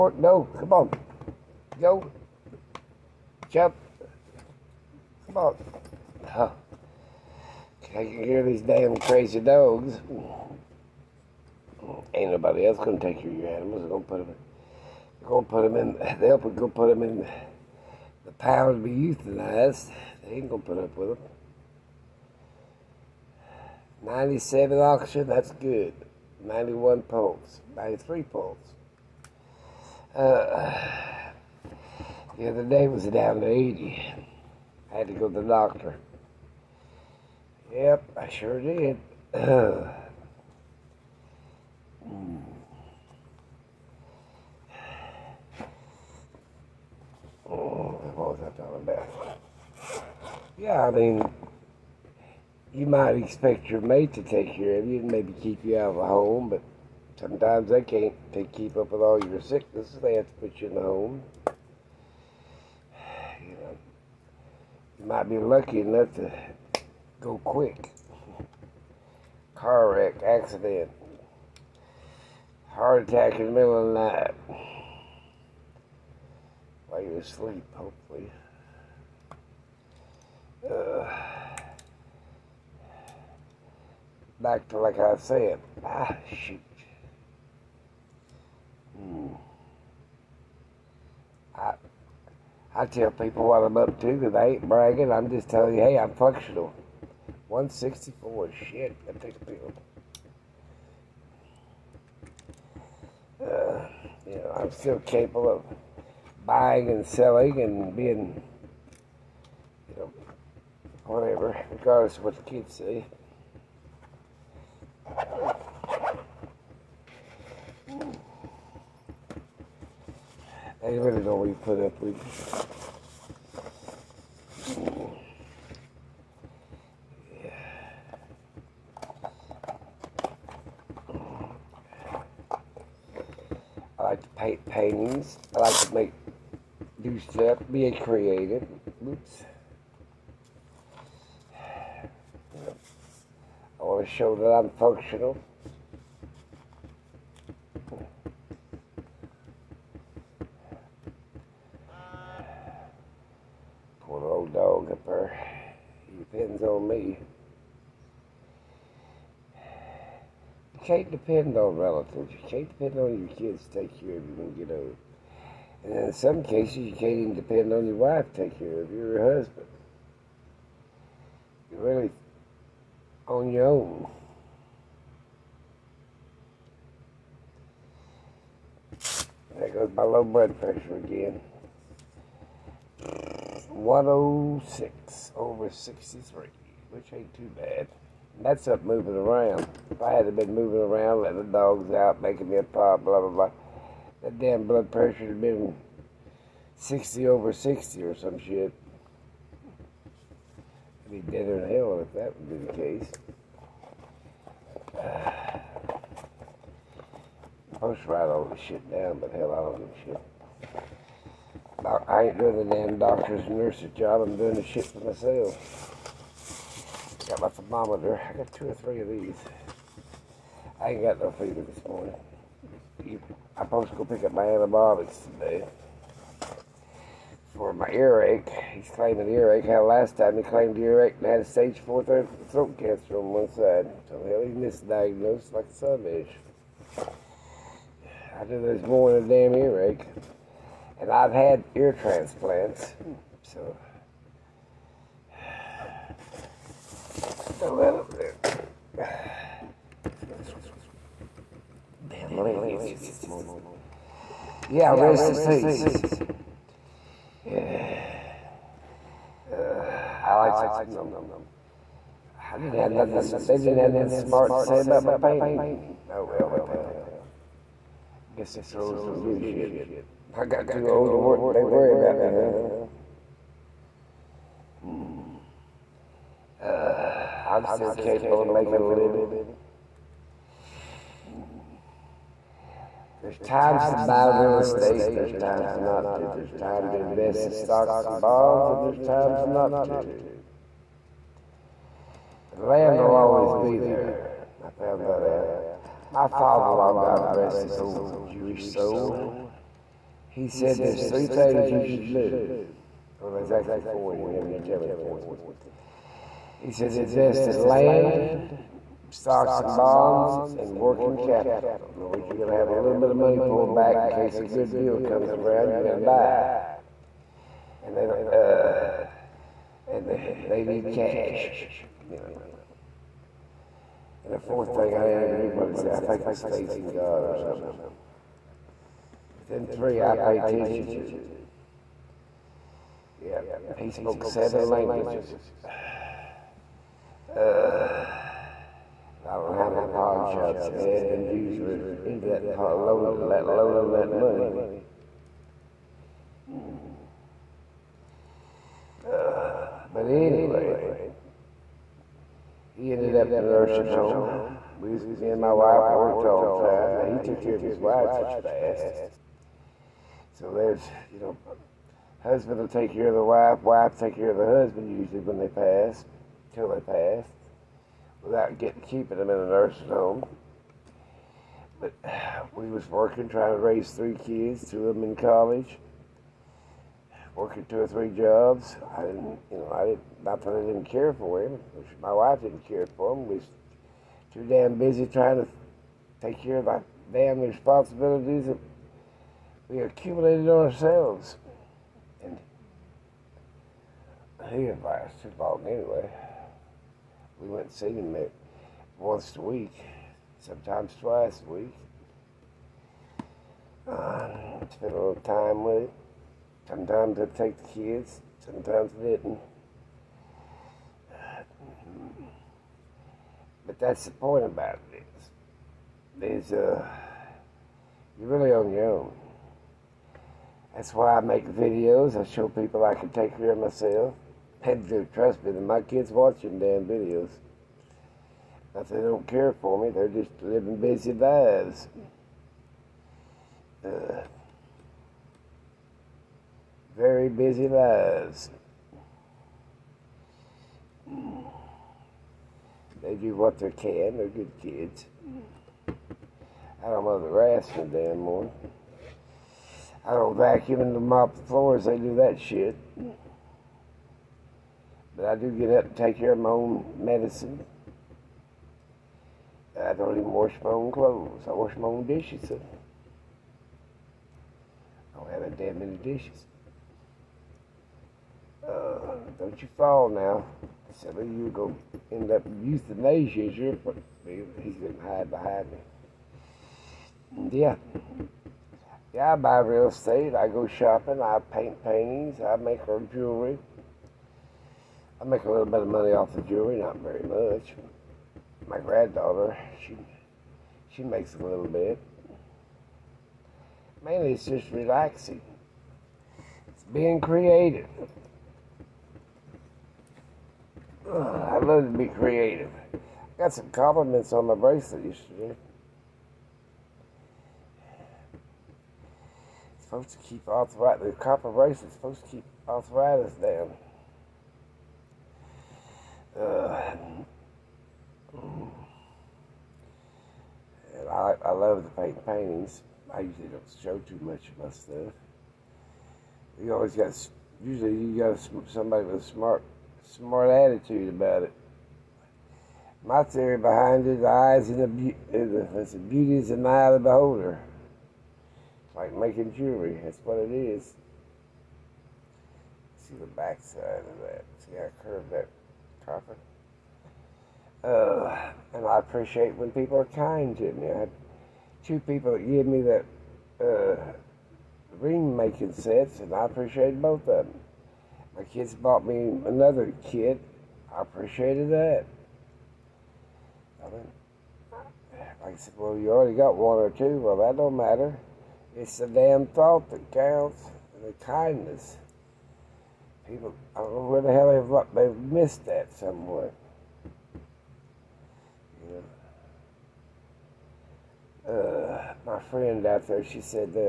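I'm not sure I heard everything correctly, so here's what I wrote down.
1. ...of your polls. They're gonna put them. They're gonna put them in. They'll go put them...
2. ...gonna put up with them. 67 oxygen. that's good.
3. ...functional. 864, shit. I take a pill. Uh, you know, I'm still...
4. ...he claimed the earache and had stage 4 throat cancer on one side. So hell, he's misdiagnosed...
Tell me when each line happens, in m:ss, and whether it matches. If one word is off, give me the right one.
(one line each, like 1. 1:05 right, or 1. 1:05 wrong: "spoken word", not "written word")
1. 0:13 wrong: "animals", not "polls"
2. 0:20 wrong: "97", not "67"
3. 1:36 wrong: "164", not "864"
4. 3:50 right.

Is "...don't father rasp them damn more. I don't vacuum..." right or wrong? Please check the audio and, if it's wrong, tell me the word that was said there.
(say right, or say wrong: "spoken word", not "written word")
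wrong: "mother", not "father".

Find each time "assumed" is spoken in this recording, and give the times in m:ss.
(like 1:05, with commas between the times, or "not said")
not said.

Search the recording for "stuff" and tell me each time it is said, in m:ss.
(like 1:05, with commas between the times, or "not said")
2:17, 8:44.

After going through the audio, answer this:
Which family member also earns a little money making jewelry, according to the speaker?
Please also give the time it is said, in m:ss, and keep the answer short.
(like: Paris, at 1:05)
Granddaughter, at 8:08.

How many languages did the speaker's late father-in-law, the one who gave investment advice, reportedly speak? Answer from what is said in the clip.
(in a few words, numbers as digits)
7.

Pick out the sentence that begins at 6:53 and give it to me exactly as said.
But that's the point about it is, there's uh, you're really on your own.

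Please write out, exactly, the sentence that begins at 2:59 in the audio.
There goes my low blood pressure again.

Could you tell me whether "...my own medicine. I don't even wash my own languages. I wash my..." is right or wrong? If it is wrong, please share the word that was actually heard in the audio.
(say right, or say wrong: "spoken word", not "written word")
wrong: "clothes", not "languages".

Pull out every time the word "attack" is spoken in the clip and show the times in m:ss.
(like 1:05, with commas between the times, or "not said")
1:13.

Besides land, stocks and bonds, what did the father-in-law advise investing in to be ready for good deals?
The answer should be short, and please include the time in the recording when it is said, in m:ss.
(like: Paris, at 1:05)
Working capital, at 5:10.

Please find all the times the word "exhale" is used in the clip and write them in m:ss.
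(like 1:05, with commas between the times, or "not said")
not said.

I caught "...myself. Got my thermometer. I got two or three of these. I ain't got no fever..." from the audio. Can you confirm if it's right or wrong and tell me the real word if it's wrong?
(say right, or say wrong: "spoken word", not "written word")
right.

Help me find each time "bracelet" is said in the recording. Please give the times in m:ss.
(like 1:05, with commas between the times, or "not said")
8:24, 8:31.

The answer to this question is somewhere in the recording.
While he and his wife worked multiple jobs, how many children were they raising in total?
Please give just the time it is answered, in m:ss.
6:13.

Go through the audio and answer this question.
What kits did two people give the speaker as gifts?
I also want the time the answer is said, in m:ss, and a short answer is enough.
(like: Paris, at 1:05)
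Ring making sets, at 9:14.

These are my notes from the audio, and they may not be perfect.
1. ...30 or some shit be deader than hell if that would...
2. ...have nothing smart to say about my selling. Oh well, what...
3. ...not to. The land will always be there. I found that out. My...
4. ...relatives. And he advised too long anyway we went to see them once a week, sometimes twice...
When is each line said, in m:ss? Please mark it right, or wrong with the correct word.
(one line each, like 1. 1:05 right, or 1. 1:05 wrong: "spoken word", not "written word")
1. 3:17 wrong: "60", not "30"
2. 4:23 wrong: "painting", not "selling"
3. 4:49 right
4. 6:30 wrong: "ourselves", not "relatives".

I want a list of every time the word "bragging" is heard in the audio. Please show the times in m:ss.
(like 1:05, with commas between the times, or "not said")
1:34.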